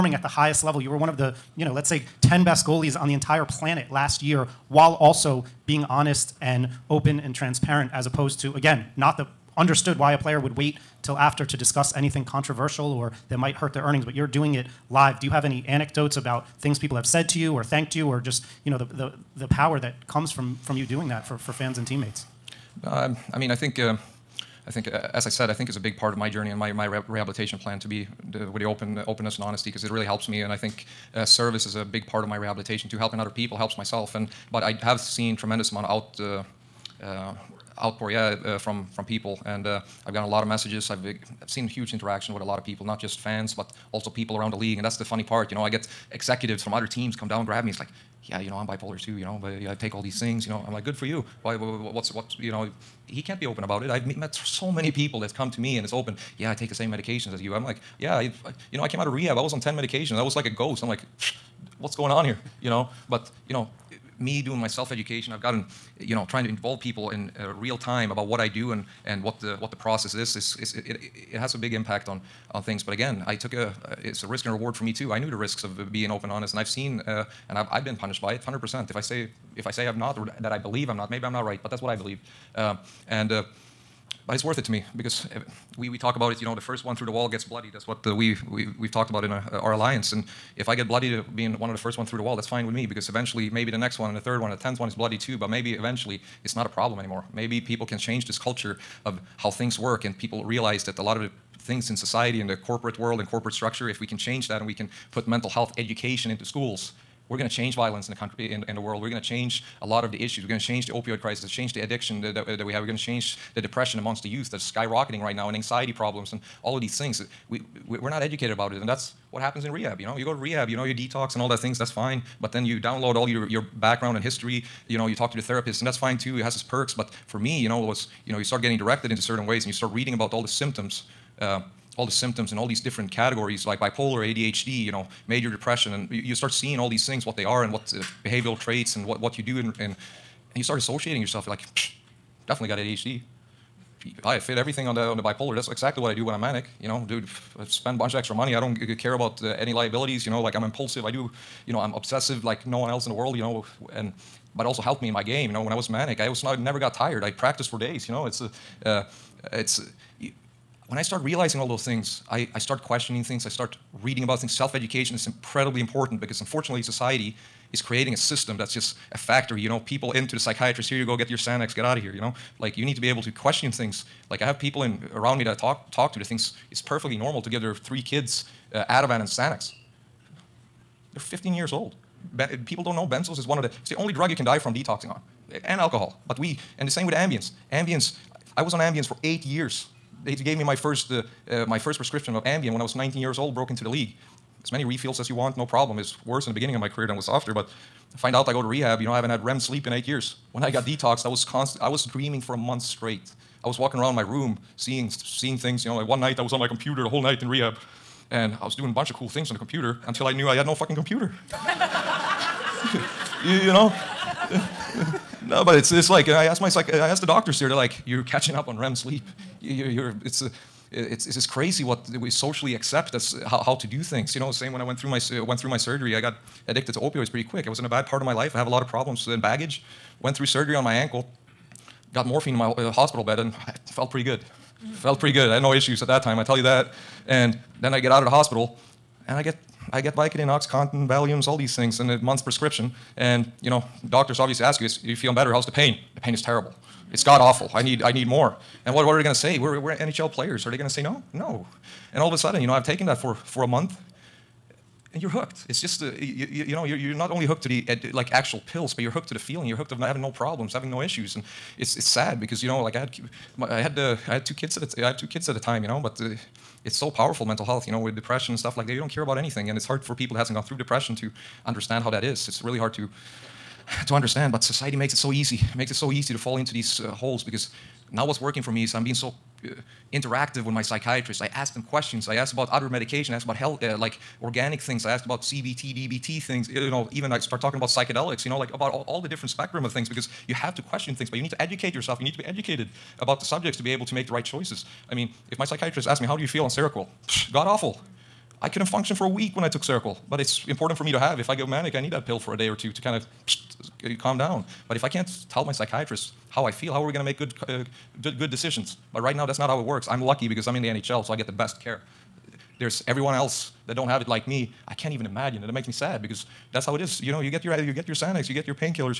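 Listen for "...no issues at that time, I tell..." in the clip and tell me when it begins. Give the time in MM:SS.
03:55.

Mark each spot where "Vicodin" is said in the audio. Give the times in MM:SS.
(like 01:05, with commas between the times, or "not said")
04:00.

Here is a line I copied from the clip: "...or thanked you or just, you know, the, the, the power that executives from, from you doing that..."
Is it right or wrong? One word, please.
wrong.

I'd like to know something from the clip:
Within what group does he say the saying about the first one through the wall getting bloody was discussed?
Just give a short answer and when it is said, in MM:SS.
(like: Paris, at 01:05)
alliance, at 01:29.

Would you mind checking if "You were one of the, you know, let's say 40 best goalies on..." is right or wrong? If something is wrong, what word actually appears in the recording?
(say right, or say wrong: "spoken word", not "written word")
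wrong: "10", not "40".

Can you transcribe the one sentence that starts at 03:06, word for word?
But we, and the same with Ambien Ambien, I was on Ambien for eight years.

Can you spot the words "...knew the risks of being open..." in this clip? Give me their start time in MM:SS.
01:15.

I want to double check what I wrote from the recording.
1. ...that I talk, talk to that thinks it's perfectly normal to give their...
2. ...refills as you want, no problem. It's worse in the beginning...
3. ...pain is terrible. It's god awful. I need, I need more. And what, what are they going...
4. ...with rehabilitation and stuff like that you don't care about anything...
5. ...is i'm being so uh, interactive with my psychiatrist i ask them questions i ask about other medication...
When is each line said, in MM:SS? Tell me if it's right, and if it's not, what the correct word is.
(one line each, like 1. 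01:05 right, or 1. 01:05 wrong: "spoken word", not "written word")
1. 02:55 right
2. 03:14 right
3. 04:06 right
4. 04:27 wrong: "depression", not "rehabilitation"
5. 04:38 right.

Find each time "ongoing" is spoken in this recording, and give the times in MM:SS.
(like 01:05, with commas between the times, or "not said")
not said.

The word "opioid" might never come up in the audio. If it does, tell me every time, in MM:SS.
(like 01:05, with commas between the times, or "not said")
01:50, 03:46.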